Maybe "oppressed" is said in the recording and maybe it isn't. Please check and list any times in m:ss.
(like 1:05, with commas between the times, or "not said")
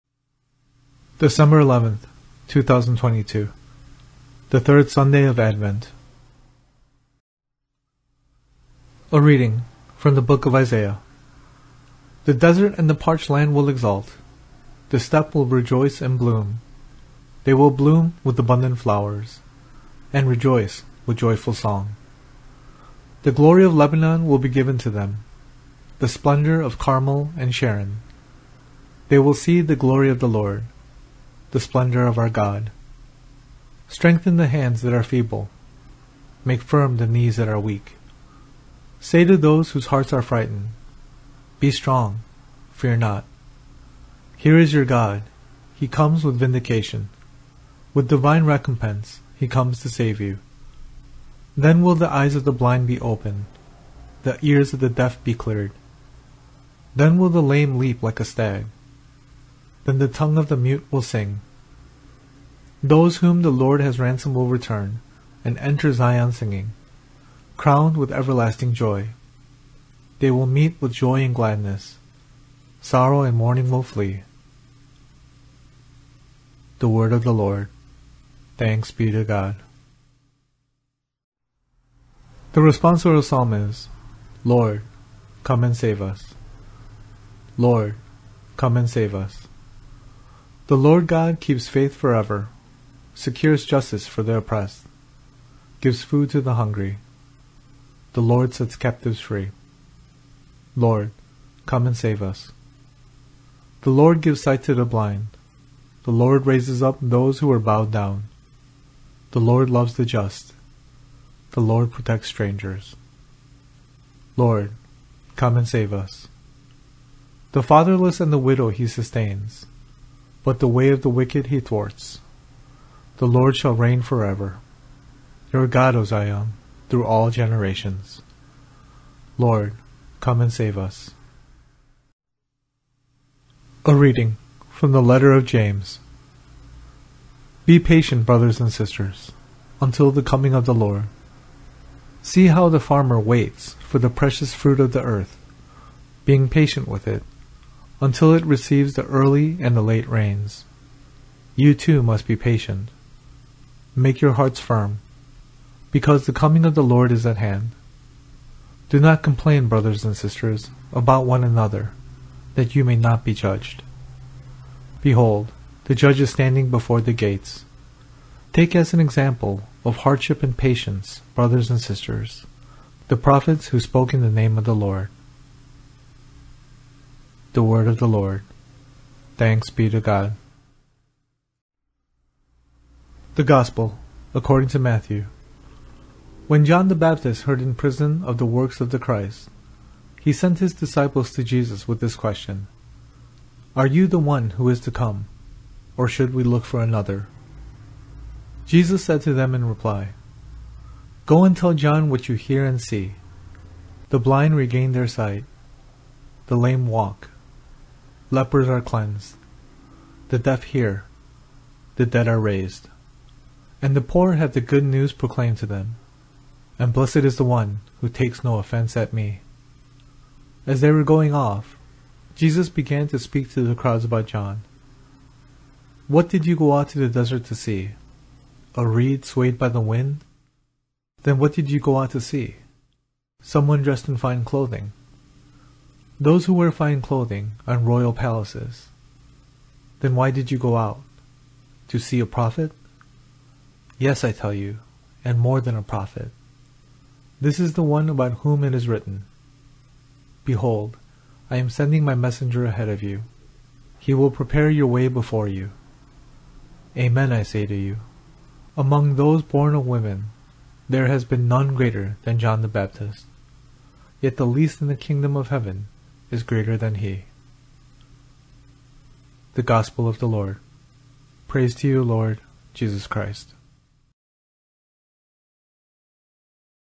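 1:34.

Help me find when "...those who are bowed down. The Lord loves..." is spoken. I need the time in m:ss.
1:47.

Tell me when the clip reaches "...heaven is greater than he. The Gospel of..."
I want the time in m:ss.
4:25.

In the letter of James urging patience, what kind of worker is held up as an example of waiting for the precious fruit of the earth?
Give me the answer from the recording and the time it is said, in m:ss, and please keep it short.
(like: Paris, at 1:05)
The farmer, at 2:22.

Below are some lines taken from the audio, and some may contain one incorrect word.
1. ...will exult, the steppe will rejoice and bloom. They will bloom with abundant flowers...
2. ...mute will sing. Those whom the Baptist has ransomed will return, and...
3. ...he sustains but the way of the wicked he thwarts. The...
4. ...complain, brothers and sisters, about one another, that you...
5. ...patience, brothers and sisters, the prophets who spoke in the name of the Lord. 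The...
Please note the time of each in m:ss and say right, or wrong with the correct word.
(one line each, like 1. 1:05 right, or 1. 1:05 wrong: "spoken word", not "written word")
1. 0:13 right
2. 1:00 wrong: "Lord", not "Baptist"
3. 1:58 right
4. 2:39 right
5. 2:50 right.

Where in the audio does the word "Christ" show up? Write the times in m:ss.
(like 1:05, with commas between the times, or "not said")
3:08, 4:33.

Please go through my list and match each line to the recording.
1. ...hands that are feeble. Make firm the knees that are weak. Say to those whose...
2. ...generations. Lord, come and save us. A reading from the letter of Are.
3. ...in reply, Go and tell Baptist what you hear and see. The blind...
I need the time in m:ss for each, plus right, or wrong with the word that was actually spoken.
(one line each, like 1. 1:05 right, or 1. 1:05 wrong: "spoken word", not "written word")
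1. 0:34 right
2. 2:07 wrong: "James", not "Are"
3. 3:19 wrong: "John", not "Baptist".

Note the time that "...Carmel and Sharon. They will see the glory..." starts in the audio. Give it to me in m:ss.
0:26.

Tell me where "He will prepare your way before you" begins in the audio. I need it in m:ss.
4:13.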